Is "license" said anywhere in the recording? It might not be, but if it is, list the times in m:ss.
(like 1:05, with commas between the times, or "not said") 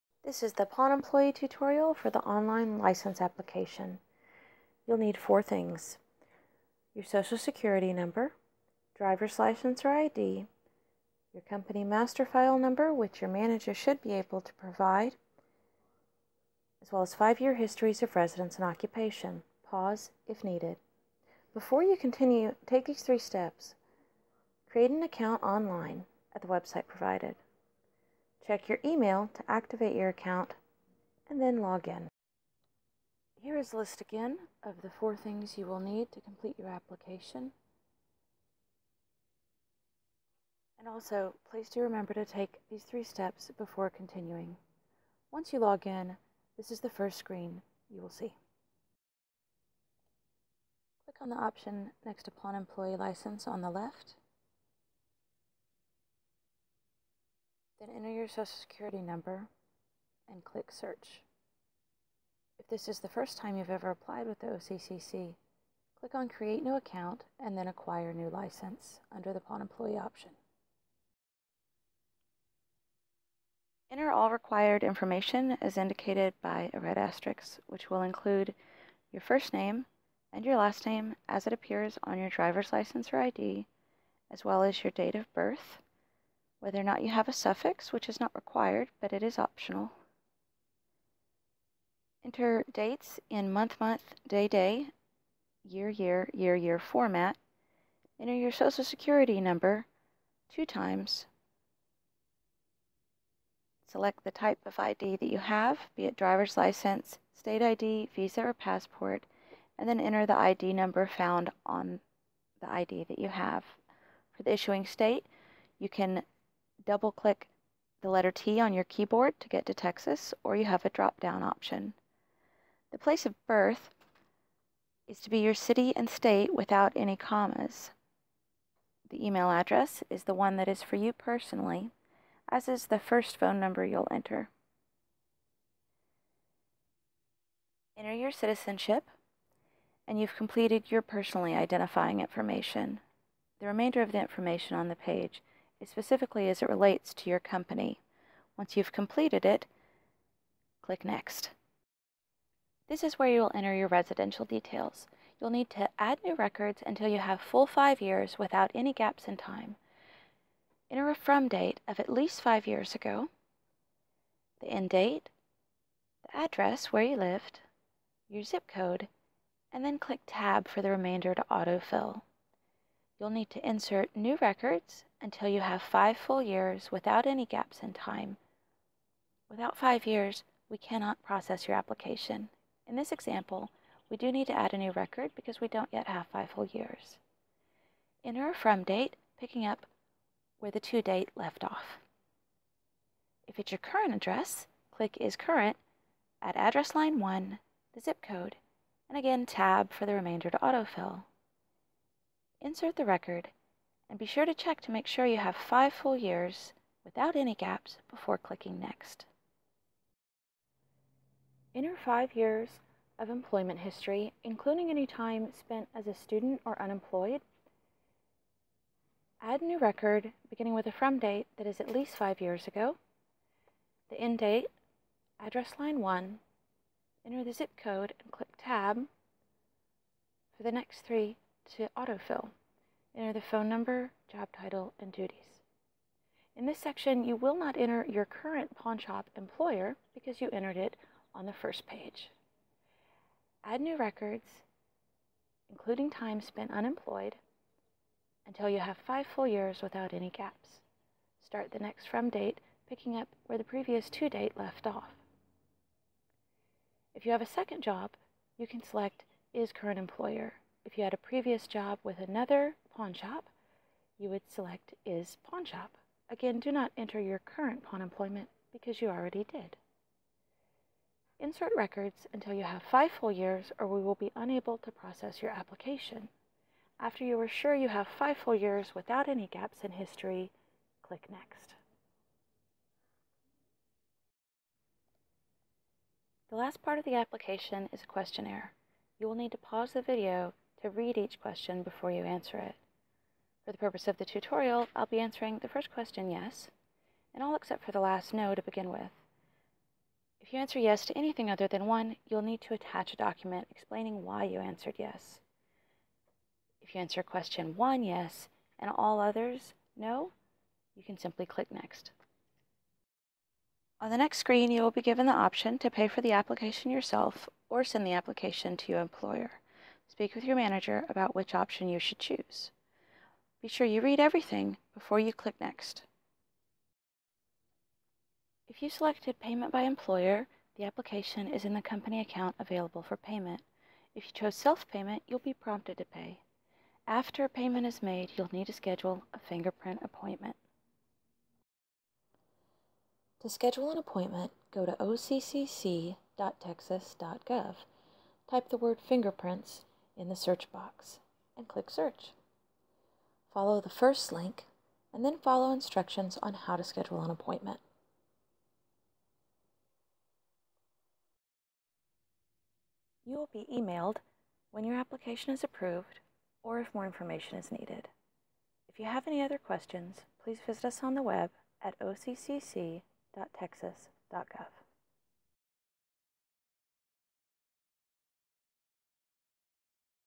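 0:02, 0:09, 0:52, 1:08, 1:22, 1:46.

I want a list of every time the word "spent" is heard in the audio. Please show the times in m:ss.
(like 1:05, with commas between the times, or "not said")
3:35, 4:06.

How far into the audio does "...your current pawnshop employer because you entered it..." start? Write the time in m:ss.
3:58.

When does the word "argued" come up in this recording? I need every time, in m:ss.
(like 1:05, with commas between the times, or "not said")
not said.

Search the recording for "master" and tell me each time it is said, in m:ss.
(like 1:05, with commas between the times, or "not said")
0:11.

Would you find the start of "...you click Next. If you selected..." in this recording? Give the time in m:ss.
5:25.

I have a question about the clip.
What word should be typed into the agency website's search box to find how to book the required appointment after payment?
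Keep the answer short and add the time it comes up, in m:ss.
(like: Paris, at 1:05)
fingerprints, at 5:48.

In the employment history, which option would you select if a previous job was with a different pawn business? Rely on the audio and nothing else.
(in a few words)
Is pawn shop.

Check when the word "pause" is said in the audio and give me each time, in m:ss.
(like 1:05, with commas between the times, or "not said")
0:19, 4:49.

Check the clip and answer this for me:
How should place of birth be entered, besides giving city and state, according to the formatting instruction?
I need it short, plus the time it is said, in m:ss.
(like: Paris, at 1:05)
Without any commas, at 2:06.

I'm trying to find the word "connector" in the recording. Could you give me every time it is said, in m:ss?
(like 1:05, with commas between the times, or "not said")
not said.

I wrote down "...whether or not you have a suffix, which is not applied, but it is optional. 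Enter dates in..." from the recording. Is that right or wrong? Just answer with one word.
wrong.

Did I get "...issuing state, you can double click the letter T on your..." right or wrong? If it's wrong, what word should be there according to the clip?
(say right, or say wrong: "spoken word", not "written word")
right.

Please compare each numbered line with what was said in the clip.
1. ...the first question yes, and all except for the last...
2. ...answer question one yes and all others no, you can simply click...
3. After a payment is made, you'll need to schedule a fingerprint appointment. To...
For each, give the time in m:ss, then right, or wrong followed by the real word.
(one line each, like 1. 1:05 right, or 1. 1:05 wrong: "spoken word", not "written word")
1. 4:55 right
2. 5:07 right
3. 5:37 right.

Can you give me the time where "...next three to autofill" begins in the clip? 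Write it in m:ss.
3:50.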